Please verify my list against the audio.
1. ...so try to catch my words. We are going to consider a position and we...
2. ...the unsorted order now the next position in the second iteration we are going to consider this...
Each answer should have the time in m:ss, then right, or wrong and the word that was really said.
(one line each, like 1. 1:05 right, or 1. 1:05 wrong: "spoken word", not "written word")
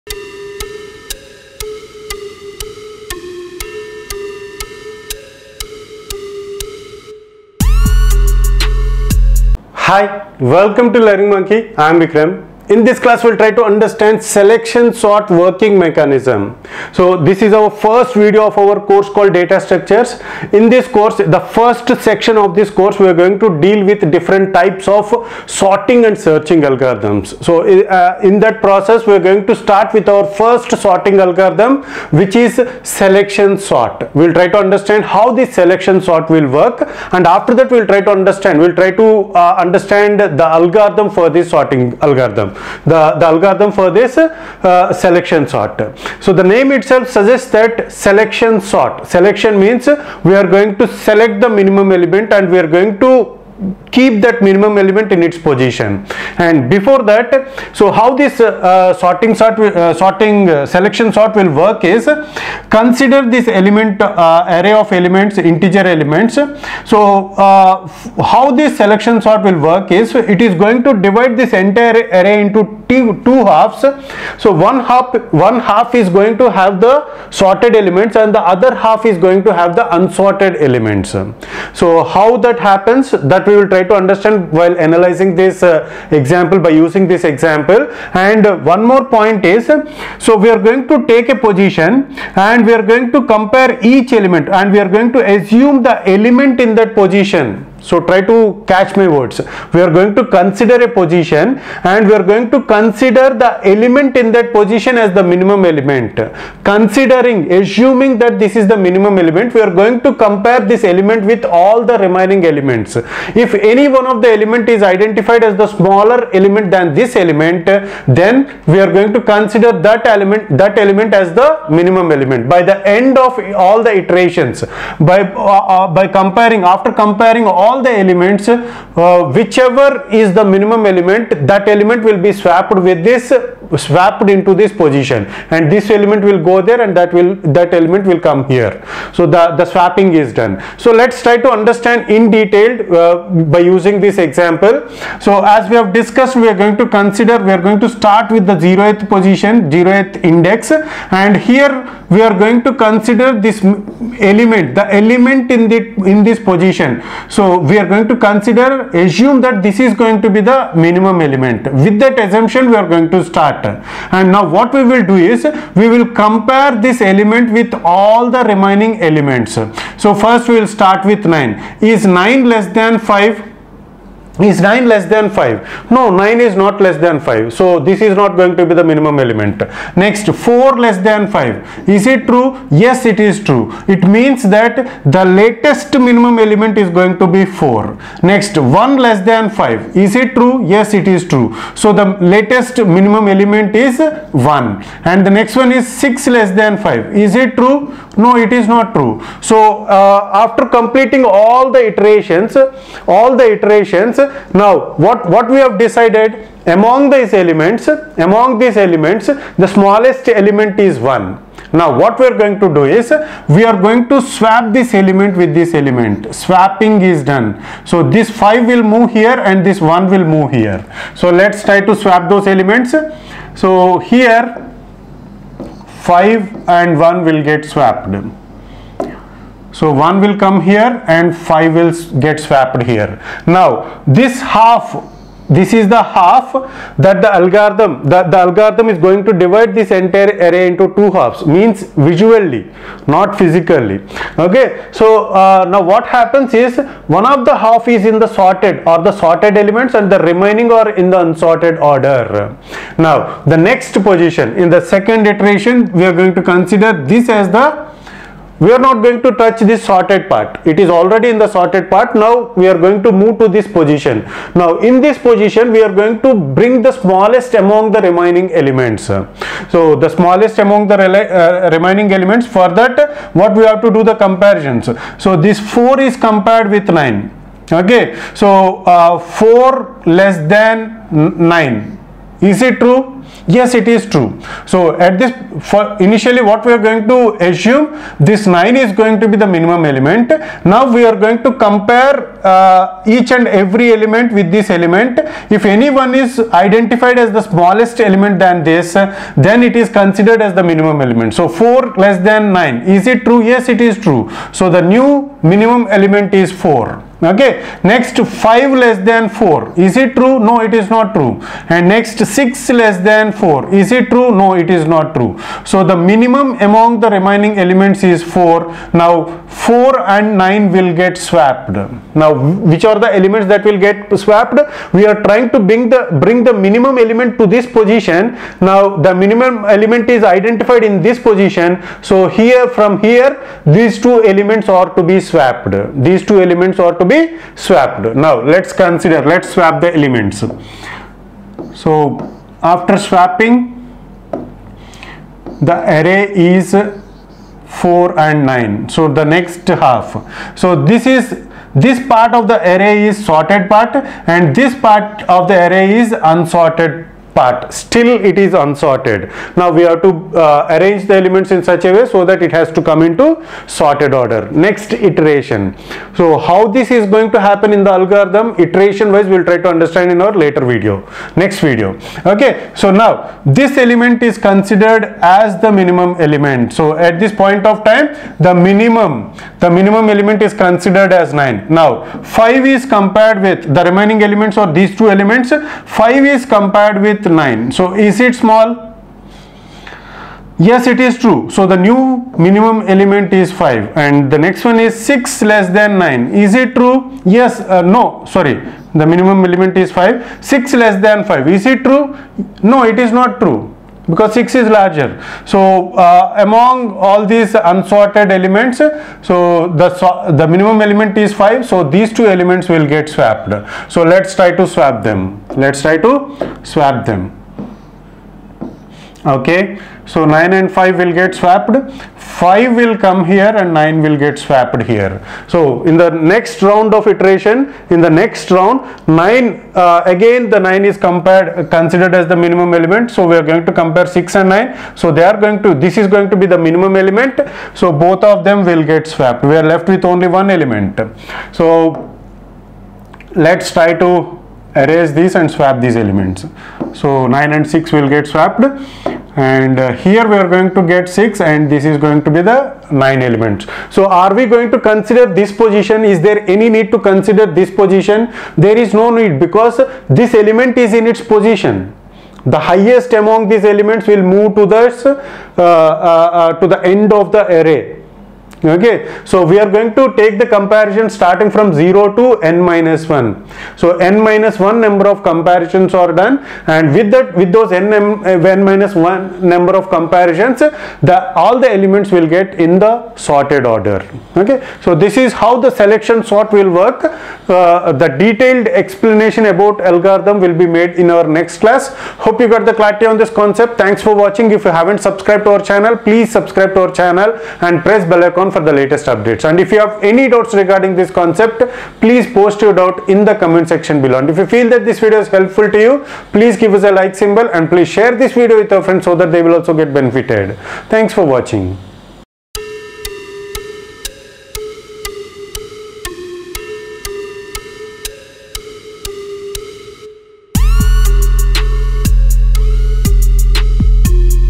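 1. 1:37 right
2. 4:11 right.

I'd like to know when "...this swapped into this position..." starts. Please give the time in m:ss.
2:13.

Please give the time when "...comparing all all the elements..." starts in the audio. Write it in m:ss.
2:06.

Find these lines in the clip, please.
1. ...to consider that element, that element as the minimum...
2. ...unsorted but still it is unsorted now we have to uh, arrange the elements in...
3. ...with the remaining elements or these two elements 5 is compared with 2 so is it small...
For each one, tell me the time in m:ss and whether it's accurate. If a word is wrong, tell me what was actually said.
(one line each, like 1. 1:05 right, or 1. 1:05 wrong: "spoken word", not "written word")
1. 1:59 right
2. 5:56 right
3. 6:23 wrong: "9", not "2".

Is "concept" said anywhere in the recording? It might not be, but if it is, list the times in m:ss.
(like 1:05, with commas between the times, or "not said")
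8:13, 8:21.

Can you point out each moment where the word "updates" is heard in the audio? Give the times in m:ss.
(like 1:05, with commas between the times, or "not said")
8:19.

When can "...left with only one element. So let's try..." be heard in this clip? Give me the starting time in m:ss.
7:19.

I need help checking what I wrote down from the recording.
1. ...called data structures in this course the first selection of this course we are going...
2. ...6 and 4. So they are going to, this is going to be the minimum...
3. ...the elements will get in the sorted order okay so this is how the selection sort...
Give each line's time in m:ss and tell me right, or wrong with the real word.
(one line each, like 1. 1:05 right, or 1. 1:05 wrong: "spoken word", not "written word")
1. 0:19 wrong: "section", not "selection"
2. 7:14 wrong: "9", not "4"
3. 8:01 right.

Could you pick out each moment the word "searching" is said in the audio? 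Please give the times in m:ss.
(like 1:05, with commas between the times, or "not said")
0:26.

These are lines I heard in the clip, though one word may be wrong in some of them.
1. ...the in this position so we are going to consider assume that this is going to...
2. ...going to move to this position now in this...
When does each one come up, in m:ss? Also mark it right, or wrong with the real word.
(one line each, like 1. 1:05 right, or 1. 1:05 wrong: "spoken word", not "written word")
1. 2:35 right
2. 4:22 right.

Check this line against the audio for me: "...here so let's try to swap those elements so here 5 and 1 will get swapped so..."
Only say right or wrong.
right.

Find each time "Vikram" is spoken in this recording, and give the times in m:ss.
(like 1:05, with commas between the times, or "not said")
0:11.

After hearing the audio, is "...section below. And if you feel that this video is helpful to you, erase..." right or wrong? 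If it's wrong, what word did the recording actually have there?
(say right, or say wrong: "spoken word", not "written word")
wrong: "please", not "erase".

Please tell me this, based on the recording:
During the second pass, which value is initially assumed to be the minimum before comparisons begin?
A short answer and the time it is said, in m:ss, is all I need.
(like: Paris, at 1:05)
9, at 4:48.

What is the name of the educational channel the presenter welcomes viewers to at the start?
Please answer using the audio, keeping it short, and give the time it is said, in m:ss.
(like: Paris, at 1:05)
Learning Monkey, at 0:11.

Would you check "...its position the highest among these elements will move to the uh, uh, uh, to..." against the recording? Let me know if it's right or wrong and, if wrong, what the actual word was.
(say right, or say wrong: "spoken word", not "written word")
right.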